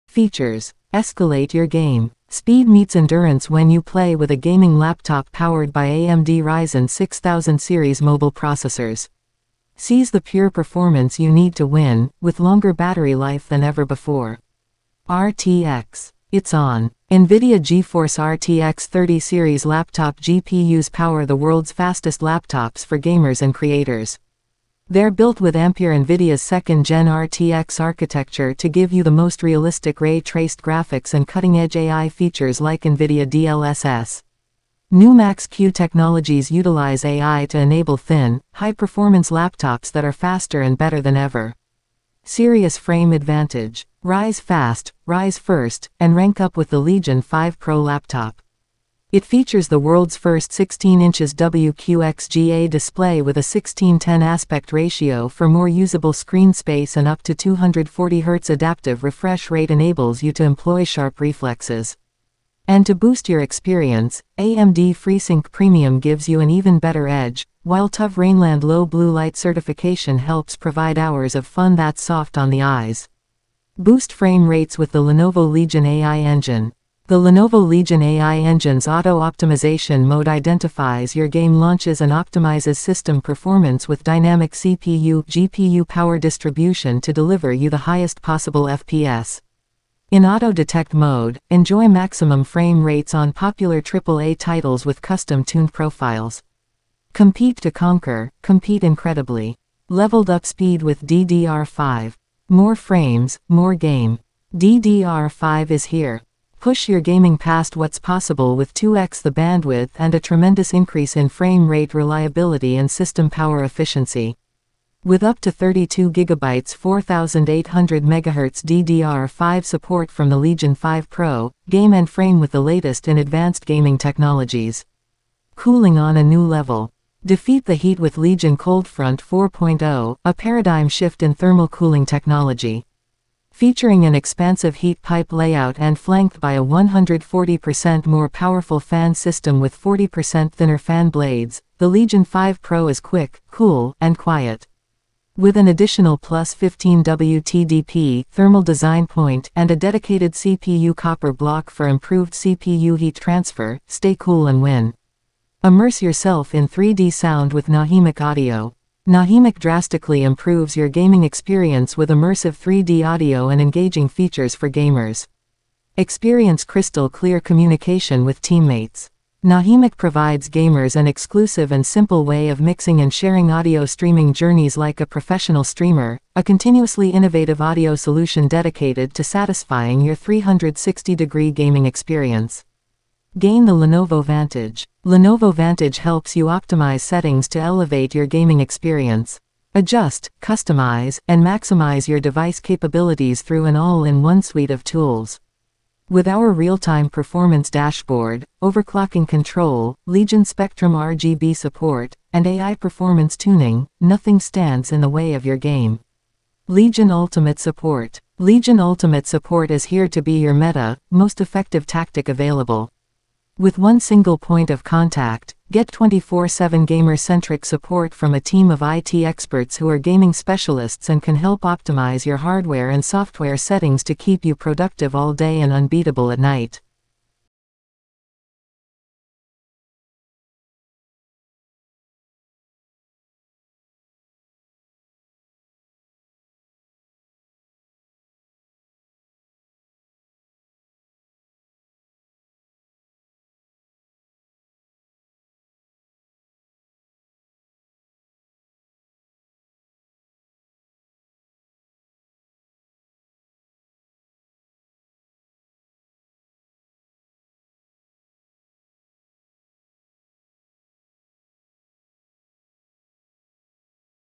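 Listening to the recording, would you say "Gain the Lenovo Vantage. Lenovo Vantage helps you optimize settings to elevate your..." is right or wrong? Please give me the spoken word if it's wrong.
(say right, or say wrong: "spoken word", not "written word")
right.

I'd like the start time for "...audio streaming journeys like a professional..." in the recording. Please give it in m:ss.
2:53.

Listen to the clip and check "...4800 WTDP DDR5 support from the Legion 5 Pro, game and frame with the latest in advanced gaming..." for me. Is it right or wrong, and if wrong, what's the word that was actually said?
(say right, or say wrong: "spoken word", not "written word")
wrong: "MHz", not "WTDP".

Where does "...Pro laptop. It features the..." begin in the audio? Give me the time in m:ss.
0:47.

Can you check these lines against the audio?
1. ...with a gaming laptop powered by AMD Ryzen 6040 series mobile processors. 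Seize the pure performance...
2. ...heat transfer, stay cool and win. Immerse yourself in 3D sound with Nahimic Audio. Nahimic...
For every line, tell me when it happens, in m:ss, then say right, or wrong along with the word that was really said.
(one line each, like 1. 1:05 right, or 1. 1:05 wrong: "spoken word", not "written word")
1. 0:04 wrong: "6000", not "6040"
2. 2:32 right.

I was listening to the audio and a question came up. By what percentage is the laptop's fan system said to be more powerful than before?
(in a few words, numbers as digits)
140%.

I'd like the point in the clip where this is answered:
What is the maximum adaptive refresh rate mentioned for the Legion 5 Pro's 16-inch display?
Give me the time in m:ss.
0:57.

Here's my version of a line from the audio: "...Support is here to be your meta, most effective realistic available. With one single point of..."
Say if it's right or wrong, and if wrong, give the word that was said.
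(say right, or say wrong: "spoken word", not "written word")
wrong: "tactic", not "realistic".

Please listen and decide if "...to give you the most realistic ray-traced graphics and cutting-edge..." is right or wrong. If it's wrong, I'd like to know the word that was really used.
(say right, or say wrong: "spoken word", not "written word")
right.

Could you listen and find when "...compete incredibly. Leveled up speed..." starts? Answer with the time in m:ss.
1:38.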